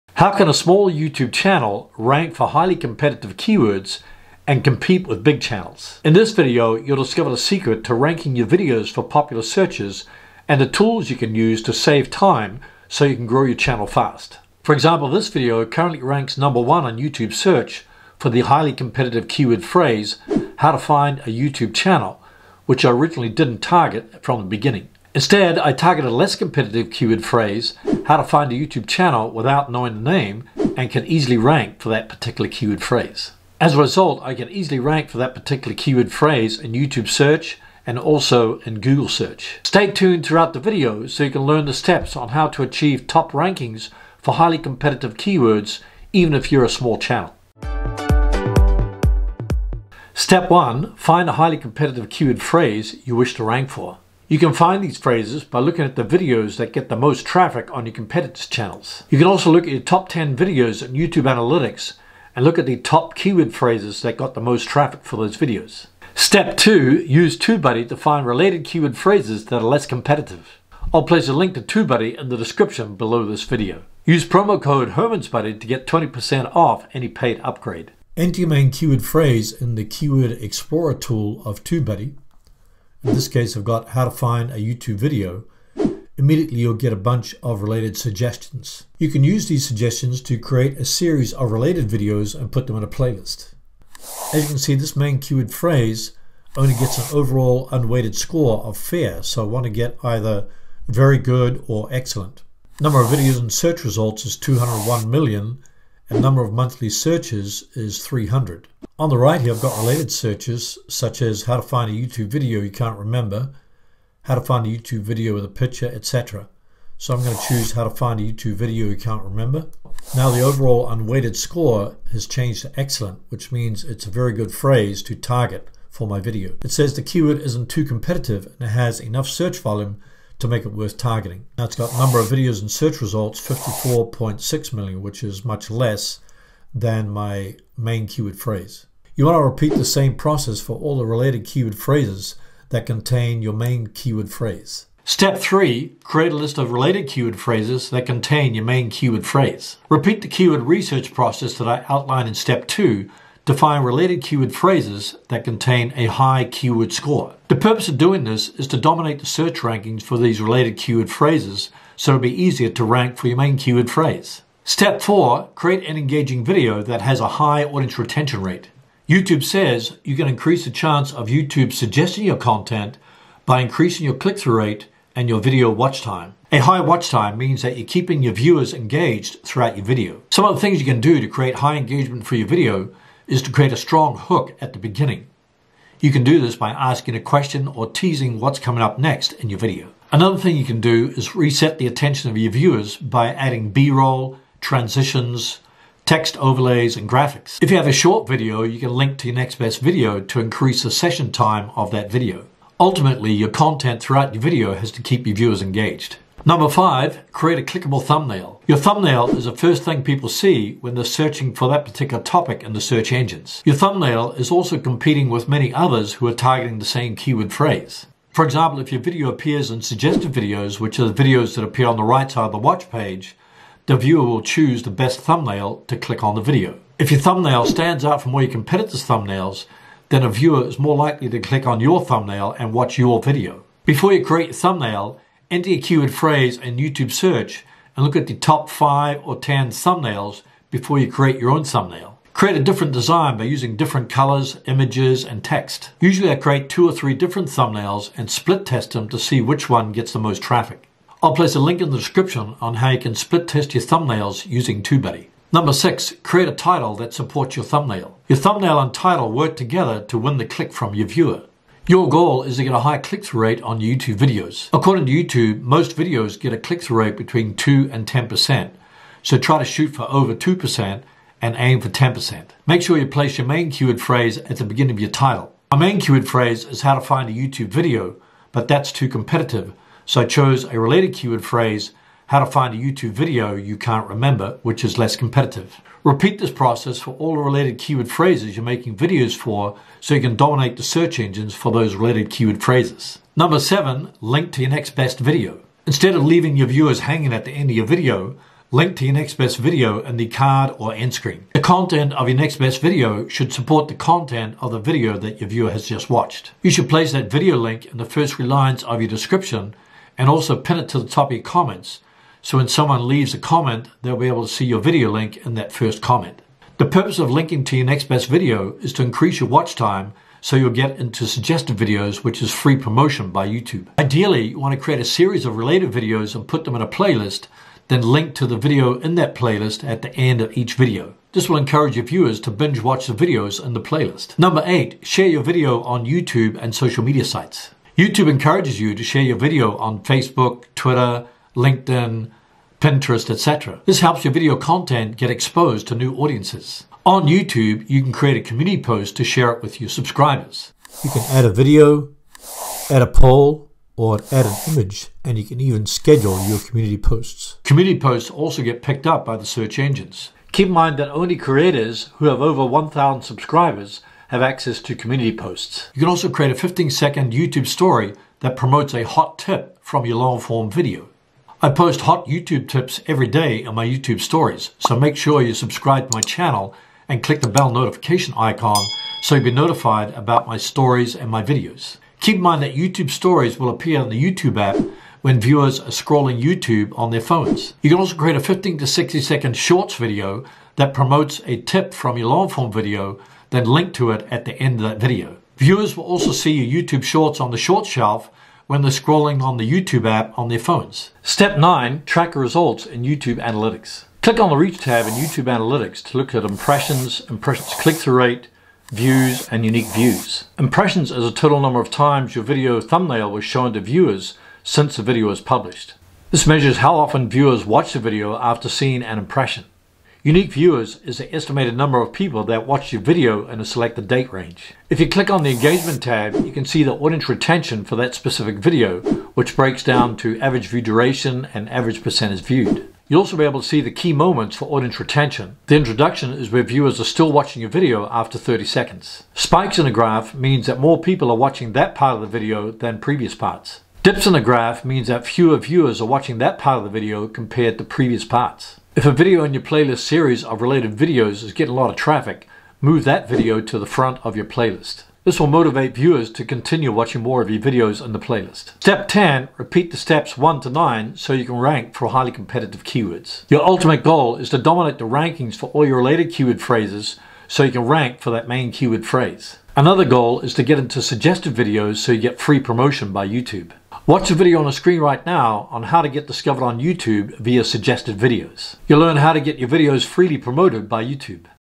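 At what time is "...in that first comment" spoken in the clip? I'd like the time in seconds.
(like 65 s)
315 s.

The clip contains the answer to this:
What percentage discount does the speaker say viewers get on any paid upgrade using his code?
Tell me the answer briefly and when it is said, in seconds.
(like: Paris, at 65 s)
20%, at 75 s.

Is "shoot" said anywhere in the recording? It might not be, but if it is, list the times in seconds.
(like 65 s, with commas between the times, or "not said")
269 s.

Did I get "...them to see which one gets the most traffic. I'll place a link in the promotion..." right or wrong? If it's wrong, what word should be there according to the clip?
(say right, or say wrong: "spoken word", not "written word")
wrong: "description", not "promotion".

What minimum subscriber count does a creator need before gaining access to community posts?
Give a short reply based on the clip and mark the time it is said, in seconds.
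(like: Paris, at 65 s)
1,000, at 362 s.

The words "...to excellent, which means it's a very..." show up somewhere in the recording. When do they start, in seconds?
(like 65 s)
122 s.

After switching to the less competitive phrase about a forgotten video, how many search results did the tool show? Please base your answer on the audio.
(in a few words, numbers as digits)
54.6 million.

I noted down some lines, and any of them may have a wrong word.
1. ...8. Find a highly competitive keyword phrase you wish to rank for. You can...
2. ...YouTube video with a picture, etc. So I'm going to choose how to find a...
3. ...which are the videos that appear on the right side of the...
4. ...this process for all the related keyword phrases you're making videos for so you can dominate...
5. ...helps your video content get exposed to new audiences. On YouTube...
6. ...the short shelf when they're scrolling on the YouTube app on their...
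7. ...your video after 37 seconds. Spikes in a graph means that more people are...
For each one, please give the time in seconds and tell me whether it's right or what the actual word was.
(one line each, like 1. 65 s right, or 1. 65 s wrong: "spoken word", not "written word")
1. 50 s wrong: "1", not "8"
2. 114 s right
3. 220 s right
4. 286 s right
5. 343 s right
6. 397 s right
7. 437 s wrong: "30", not "37".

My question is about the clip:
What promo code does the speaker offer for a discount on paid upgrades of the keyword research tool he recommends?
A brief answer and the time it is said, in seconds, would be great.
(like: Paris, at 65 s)
HermansBuddy, at 74 s.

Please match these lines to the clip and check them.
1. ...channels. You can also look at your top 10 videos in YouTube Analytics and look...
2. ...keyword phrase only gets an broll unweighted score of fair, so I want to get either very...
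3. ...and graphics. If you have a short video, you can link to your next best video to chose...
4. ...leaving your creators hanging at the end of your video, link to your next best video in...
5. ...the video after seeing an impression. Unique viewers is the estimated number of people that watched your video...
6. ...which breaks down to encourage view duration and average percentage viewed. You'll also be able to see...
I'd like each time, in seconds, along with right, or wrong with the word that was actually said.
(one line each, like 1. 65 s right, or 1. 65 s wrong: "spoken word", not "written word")
1. 58 s right
2. 95 s wrong: "overall", not "broll"
3. 196 s wrong: "increase", not "chose"
4. 296 s wrong: "viewers", not "creators"
5. 417 s right
6. 429 s wrong: "average", not "encourage".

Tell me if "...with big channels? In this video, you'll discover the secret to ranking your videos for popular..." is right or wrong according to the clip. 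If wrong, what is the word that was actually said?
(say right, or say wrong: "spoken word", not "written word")
right.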